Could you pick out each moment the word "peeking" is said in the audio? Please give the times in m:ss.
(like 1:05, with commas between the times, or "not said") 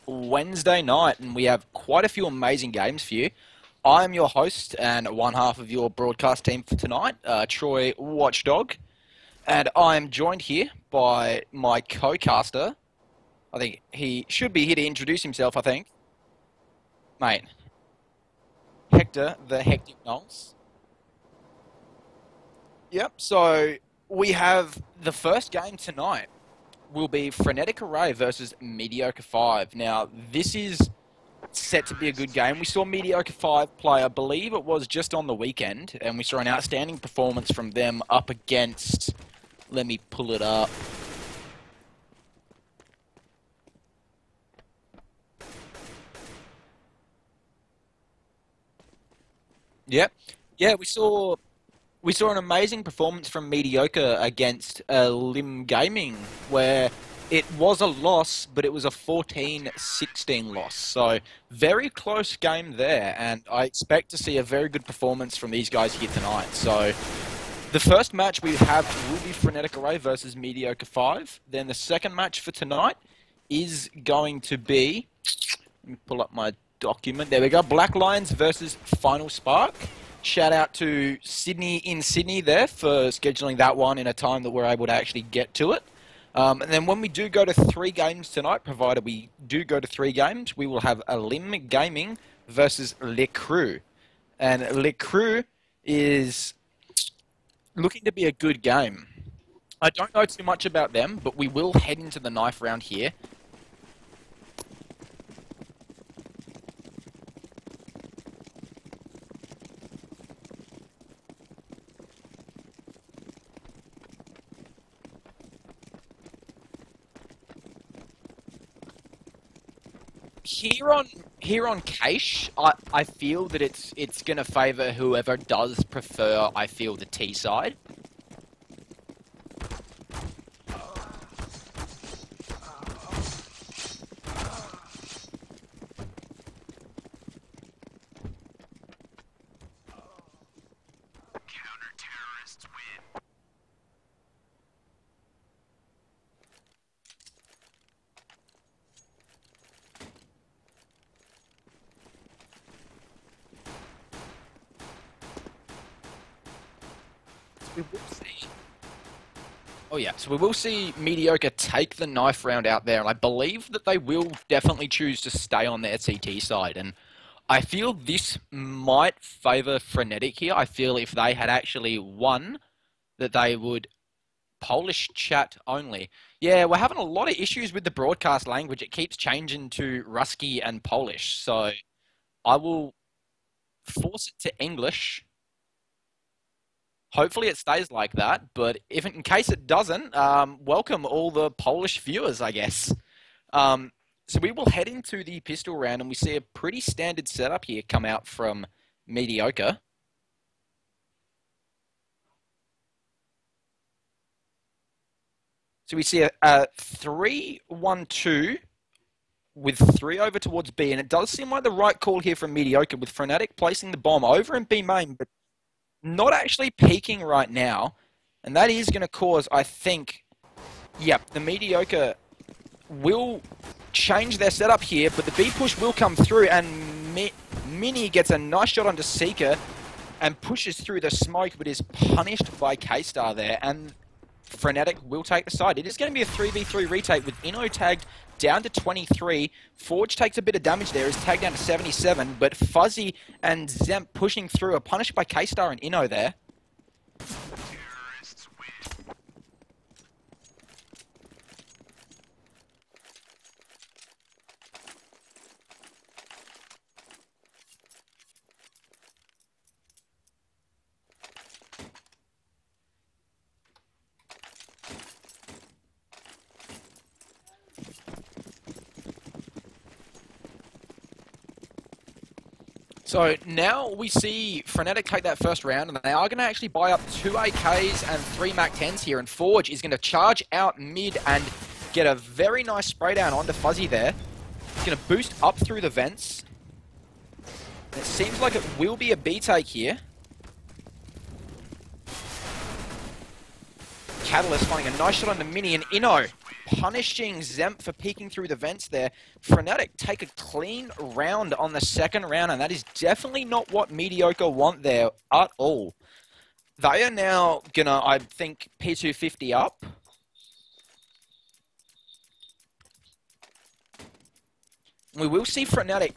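3:36, 4:57.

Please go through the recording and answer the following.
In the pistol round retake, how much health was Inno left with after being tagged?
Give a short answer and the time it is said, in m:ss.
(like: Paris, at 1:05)
23, at 3:58.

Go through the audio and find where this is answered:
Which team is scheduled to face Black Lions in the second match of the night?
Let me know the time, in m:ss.
1:18.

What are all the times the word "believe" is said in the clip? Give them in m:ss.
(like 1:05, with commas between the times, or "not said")
0:34, 2:43.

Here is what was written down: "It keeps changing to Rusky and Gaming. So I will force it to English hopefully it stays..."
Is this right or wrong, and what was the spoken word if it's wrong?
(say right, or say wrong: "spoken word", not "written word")
wrong: "Polish", not "Gaming".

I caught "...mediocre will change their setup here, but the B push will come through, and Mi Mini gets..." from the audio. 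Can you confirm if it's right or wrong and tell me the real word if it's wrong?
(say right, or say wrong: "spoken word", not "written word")
right.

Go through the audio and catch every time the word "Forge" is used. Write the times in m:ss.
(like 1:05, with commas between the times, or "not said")
3:59, 4:39.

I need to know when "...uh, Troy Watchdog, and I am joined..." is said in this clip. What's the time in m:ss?
0:07.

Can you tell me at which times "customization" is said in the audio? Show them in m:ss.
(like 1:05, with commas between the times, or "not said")
not said.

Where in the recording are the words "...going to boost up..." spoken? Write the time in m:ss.
4:44.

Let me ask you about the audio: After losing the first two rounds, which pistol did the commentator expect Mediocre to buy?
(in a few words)
P250.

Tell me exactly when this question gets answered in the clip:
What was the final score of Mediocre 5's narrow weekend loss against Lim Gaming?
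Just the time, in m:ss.
0:58.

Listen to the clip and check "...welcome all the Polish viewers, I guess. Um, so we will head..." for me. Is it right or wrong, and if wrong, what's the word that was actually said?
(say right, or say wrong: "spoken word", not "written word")
right.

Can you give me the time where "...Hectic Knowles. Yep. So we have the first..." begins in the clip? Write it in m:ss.
0:19.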